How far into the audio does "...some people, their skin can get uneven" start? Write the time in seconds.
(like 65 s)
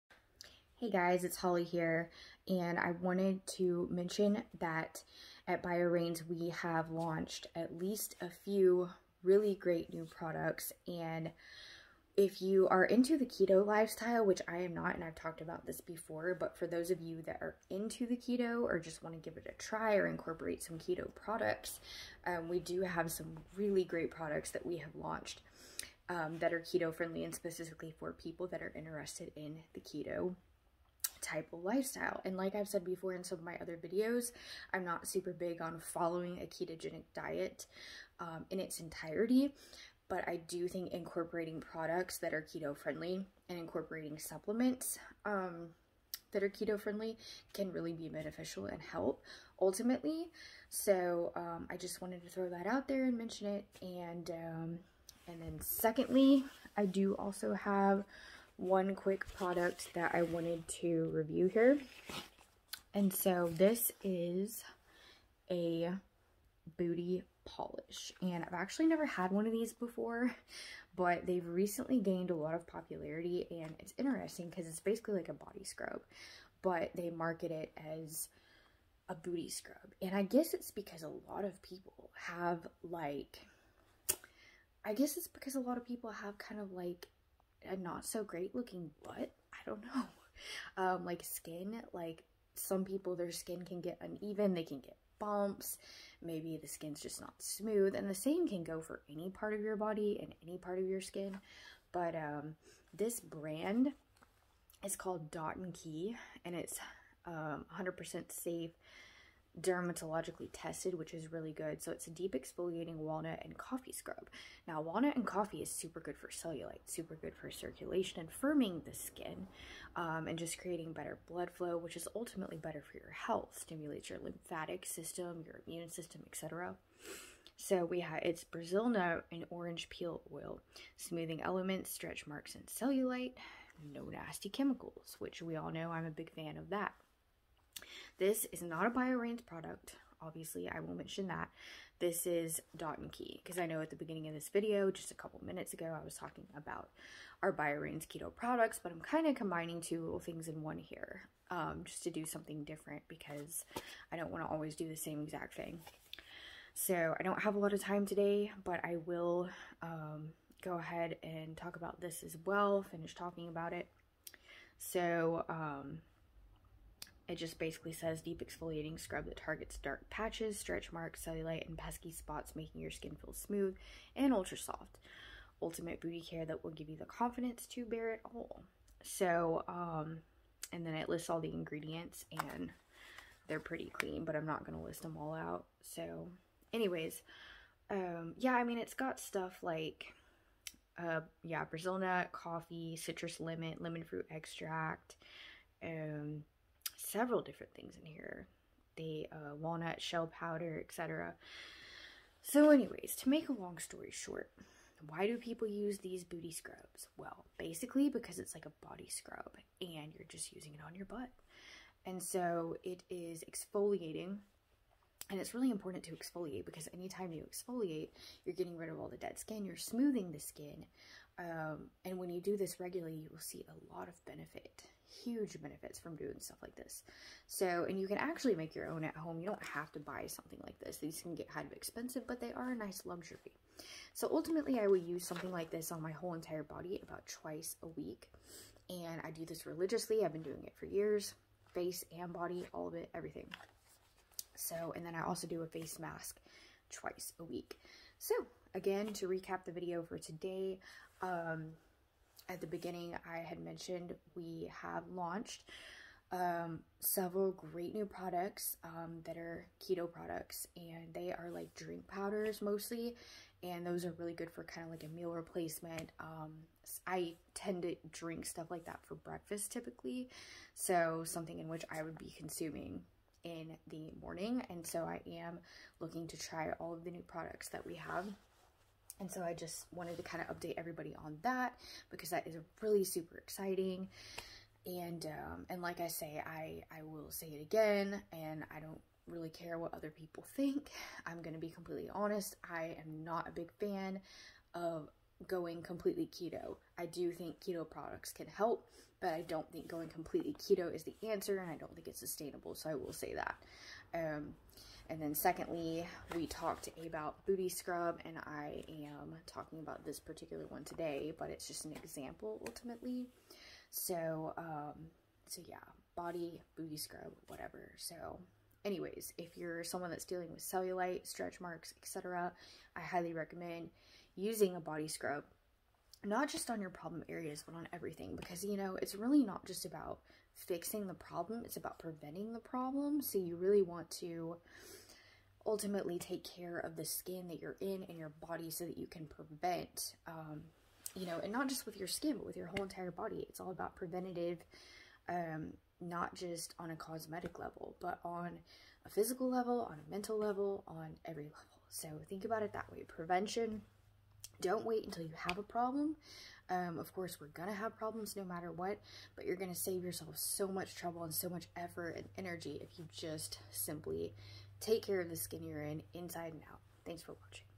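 92 s.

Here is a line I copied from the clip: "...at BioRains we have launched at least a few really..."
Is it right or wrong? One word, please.
right.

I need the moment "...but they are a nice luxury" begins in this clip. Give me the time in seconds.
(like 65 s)
232 s.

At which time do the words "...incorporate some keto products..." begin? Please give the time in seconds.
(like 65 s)
20 s.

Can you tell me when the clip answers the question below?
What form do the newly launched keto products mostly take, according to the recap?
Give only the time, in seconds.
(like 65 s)
261 s.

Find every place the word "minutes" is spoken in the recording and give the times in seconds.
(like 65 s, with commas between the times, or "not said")
145 s.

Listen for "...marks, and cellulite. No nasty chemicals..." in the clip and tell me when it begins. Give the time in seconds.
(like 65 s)
132 s.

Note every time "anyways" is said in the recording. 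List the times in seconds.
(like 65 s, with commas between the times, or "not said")
186 s, 202 s, 318 s.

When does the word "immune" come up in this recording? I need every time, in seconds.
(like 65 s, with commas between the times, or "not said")
125 s.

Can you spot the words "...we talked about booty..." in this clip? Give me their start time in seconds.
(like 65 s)
306 s.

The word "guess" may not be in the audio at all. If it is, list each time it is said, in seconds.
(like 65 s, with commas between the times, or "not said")
80 s, 84 s.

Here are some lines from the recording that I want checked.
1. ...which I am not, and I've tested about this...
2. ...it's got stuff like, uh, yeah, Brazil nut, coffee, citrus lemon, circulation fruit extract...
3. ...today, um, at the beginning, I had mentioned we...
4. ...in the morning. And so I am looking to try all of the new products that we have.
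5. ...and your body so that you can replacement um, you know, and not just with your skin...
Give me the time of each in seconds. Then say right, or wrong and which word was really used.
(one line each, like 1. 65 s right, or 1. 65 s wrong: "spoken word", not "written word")
1. 14 s wrong: "talked", not "tested"
2. 188 s wrong: "lemon", not "circulation"
3. 250 s right
4. 273 s right
5. 338 s wrong: "prevent", not "replacement".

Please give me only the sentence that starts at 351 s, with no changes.
So think about it that way.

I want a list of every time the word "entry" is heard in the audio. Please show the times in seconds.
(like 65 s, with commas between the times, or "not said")
not said.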